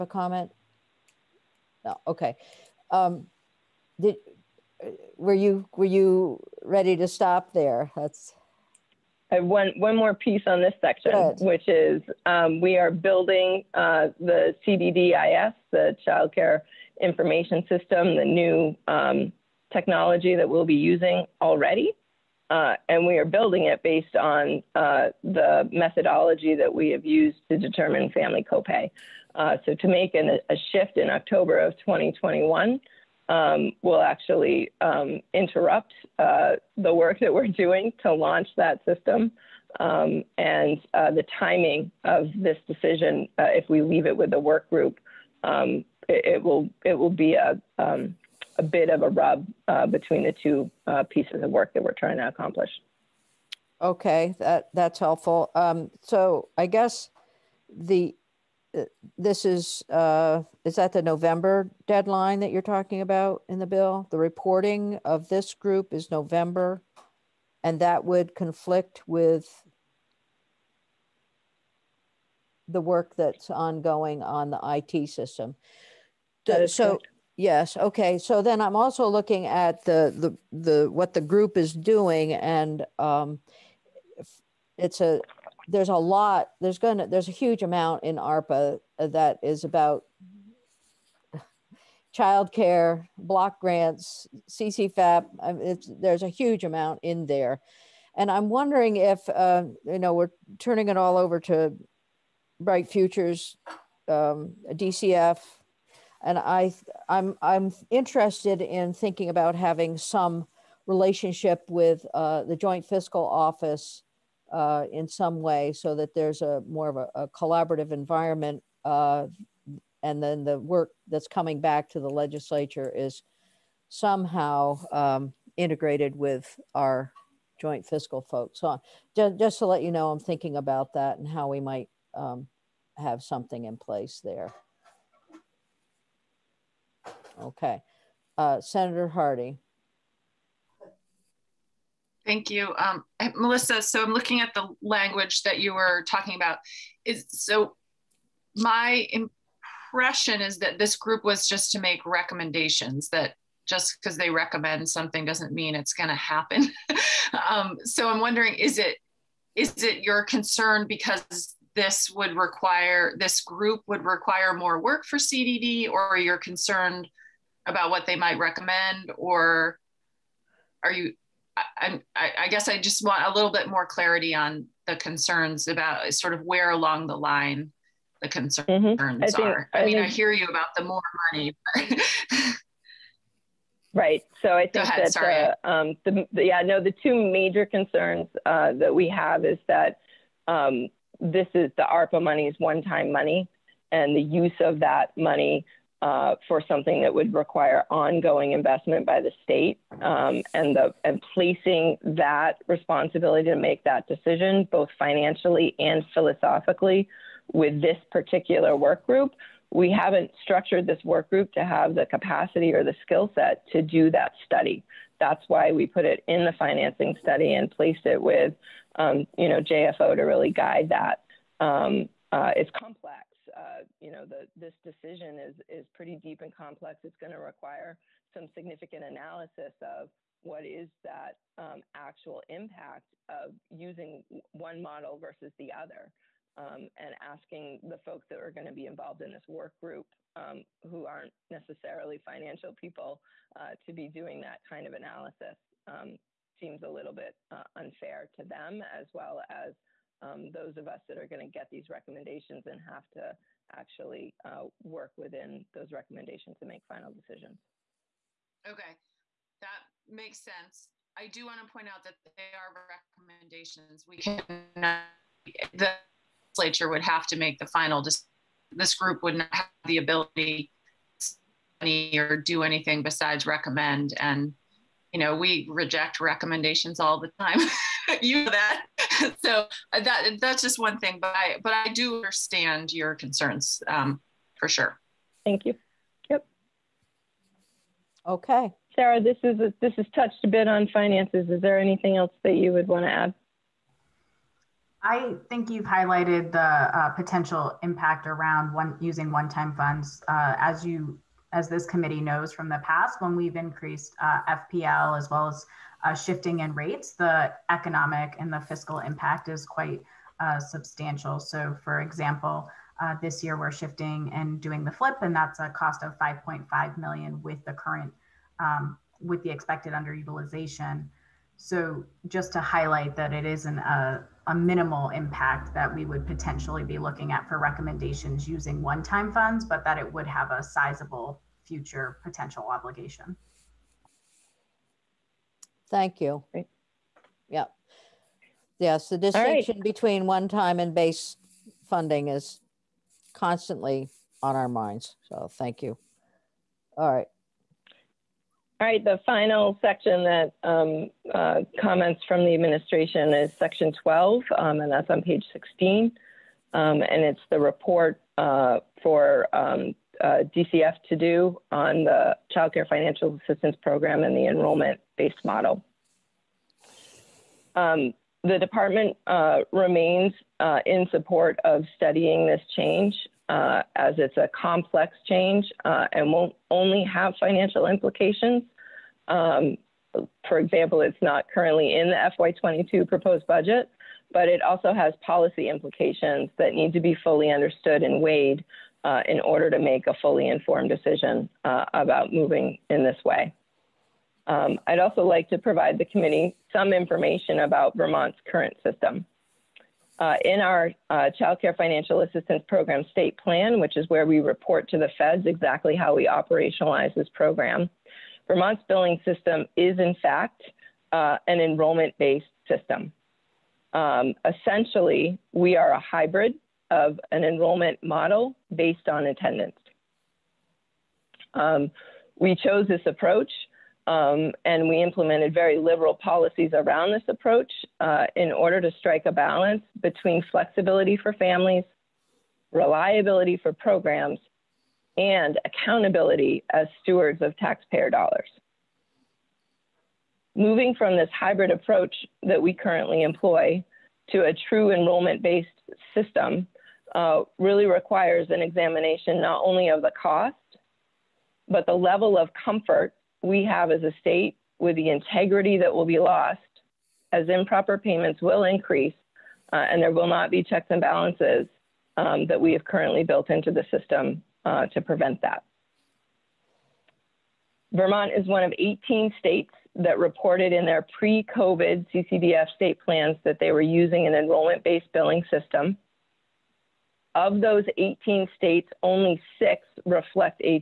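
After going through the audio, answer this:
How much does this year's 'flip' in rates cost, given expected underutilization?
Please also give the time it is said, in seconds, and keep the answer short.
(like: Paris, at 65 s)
5.5 million, at 316 s.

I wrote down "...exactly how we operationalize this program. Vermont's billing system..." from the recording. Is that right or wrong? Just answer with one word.
right.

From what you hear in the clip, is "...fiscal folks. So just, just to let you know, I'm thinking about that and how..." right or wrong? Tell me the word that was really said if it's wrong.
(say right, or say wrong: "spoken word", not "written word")
right.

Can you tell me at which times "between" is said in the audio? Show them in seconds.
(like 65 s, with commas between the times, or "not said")
49 s, 339 s, 430 s.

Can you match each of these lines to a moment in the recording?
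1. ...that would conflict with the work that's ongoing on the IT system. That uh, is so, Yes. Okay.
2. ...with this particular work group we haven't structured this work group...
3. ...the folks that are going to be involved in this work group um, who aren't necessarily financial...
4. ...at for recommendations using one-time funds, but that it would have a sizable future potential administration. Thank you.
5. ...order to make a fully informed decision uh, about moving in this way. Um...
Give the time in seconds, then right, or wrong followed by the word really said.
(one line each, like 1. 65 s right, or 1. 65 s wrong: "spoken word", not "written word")
1. 67 s right
2. 207 s right
3. 237 s right
4. 327 s wrong: "obligation", not "administration"
5. 389 s right.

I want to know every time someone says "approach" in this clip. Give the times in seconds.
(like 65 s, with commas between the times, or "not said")
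423 s, 427 s, 441 s.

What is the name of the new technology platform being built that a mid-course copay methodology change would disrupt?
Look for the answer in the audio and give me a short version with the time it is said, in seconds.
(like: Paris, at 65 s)
Child Care Information System, at 16 s.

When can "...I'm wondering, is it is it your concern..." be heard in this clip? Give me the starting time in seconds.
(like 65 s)
158 s.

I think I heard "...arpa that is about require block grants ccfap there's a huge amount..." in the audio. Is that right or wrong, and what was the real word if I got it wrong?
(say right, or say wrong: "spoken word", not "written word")
wrong: "childcare", not "require".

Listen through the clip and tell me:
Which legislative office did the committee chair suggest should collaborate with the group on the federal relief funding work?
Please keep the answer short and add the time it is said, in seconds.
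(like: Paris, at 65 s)
Joint Fiscal Office, at 112 s.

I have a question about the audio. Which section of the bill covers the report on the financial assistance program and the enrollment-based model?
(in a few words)
Section 12.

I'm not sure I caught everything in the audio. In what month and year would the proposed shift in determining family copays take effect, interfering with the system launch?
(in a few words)
October 2021.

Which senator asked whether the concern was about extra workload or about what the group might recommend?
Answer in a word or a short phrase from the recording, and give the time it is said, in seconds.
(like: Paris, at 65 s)
Senator Hardy, at 138 s.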